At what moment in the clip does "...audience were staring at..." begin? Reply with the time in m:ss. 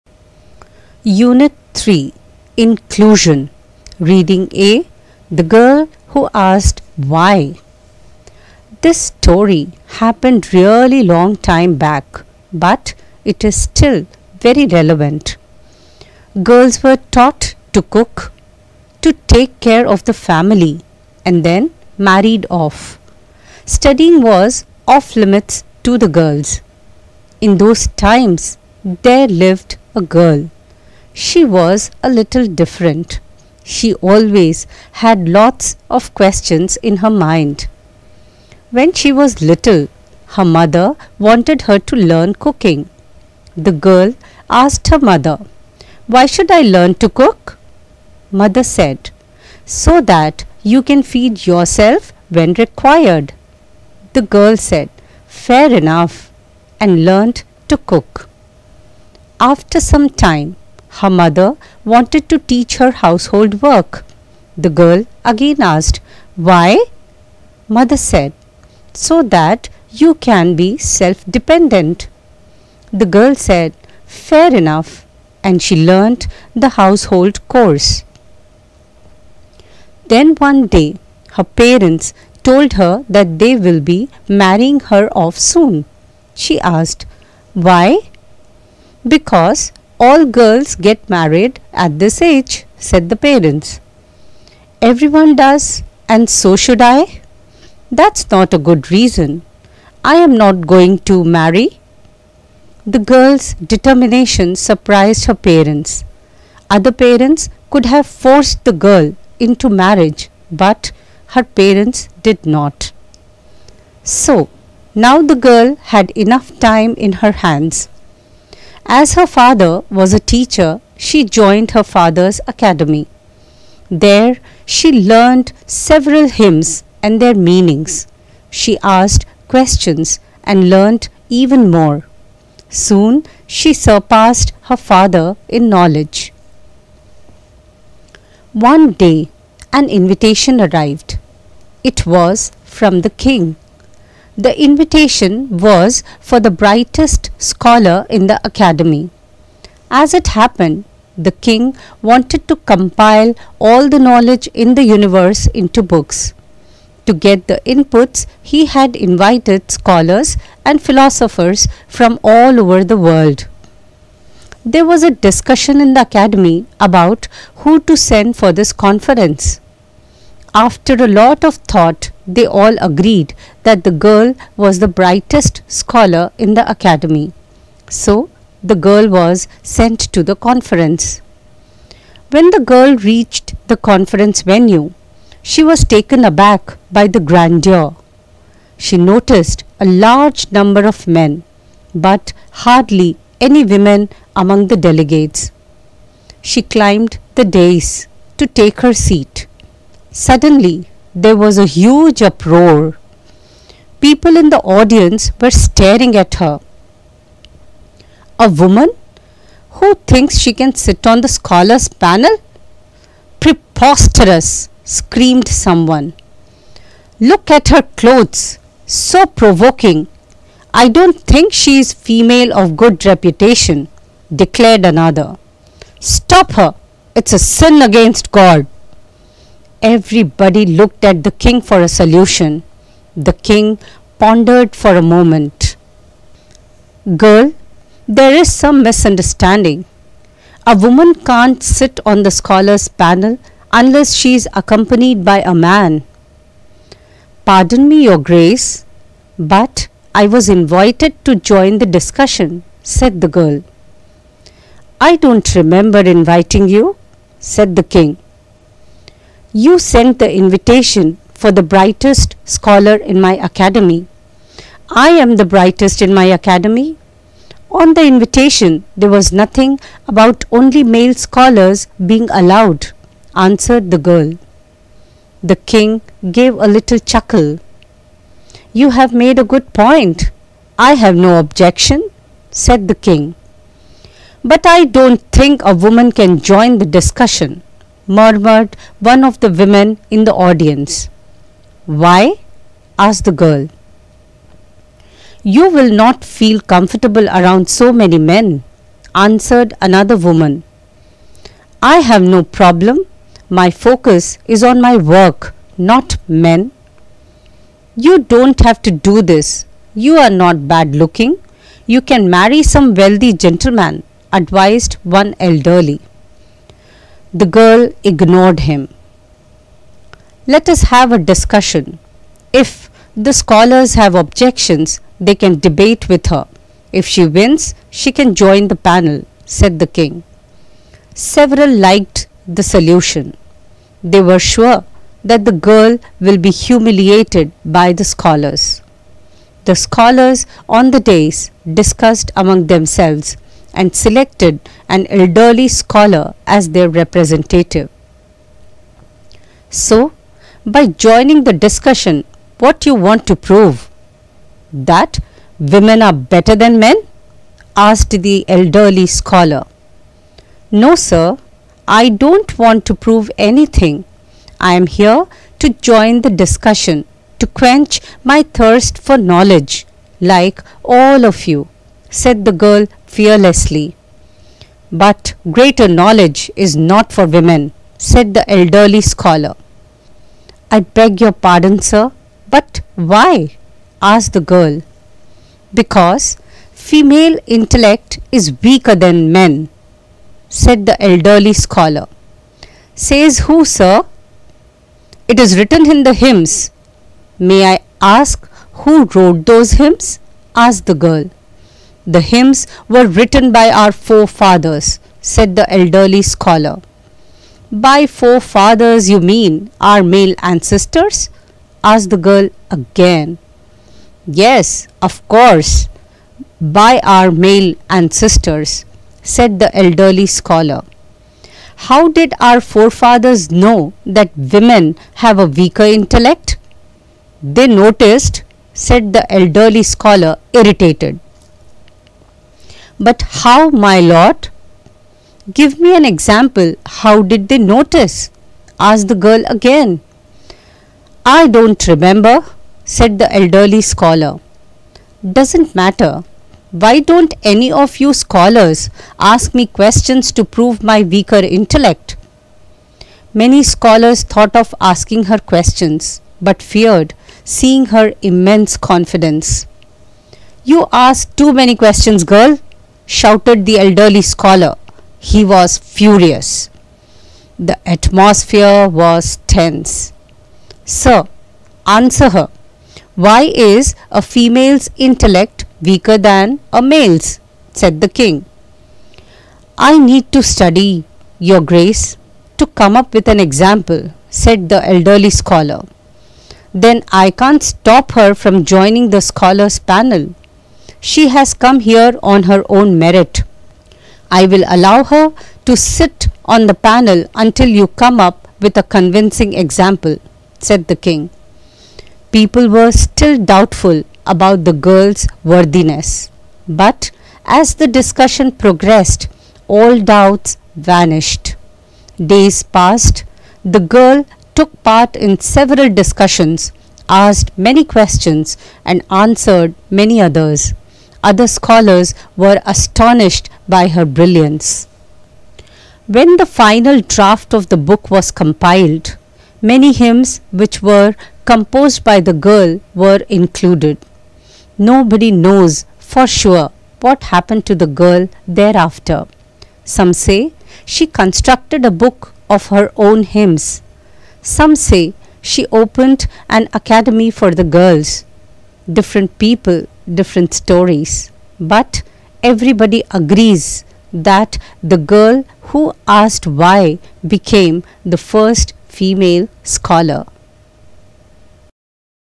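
3:24.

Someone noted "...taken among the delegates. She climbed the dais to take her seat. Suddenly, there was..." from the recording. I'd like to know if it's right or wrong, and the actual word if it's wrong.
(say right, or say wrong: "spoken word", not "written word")
wrong: "women", not "taken".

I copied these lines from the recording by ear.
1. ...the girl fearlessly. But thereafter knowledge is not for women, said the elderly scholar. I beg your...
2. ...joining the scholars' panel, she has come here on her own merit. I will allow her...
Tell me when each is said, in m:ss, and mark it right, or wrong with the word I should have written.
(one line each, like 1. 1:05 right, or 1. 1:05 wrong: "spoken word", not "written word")
1. 6:12 wrong: "greater", not "thereafter"
2. 8:08 right.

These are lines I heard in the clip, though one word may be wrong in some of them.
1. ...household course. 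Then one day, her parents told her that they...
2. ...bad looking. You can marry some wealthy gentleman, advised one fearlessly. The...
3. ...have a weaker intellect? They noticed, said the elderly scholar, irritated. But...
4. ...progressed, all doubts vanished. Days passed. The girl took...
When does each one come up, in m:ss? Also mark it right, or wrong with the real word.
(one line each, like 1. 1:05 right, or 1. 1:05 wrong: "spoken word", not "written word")
1. 1:16 right
2. 5:10 wrong: "elderly", not "fearlessly"
3. 7:05 right
4. 8:28 right.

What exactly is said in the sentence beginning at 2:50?
After a lot of thought, they all agreed that the girl was the brightest scholar in the academy.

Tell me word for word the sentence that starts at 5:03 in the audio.
My focus is on my work, not men.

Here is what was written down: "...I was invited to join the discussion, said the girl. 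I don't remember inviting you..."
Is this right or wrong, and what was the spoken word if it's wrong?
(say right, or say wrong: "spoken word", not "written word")
right.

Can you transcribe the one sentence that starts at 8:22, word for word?
People were still doubtful about the girl's worthiness.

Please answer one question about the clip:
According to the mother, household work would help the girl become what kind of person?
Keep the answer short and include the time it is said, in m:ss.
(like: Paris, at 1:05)
Self dependent, at 1:10.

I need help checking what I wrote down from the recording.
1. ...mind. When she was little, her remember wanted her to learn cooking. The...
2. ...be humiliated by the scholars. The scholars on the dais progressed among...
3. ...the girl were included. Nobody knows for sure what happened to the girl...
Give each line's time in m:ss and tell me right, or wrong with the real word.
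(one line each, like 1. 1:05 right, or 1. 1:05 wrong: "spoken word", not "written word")
1. 0:37 wrong: "mother", not "remember"
2. 5:36 wrong: "discussed", not "progressed"
3. 8:52 right.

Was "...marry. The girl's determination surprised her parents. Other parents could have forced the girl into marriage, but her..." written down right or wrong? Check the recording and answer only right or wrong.
right.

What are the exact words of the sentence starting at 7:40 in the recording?
You ask too many questions, girl, shouted the elderly scholar.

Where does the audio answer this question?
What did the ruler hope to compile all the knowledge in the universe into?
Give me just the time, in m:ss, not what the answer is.
2:35.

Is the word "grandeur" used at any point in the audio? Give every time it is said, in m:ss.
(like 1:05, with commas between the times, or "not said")
3:07.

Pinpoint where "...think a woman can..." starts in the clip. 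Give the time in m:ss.
4:45.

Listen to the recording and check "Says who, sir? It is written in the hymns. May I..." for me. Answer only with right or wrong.
right.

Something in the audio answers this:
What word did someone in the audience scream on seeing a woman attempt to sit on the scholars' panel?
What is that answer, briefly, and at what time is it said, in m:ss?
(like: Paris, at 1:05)
Preposterous, at 3:33.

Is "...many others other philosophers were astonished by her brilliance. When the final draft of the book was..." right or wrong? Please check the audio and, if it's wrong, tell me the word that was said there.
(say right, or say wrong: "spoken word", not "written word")
wrong: "scholars", not "philosophers".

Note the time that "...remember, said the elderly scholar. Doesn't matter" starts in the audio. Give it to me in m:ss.
7:21.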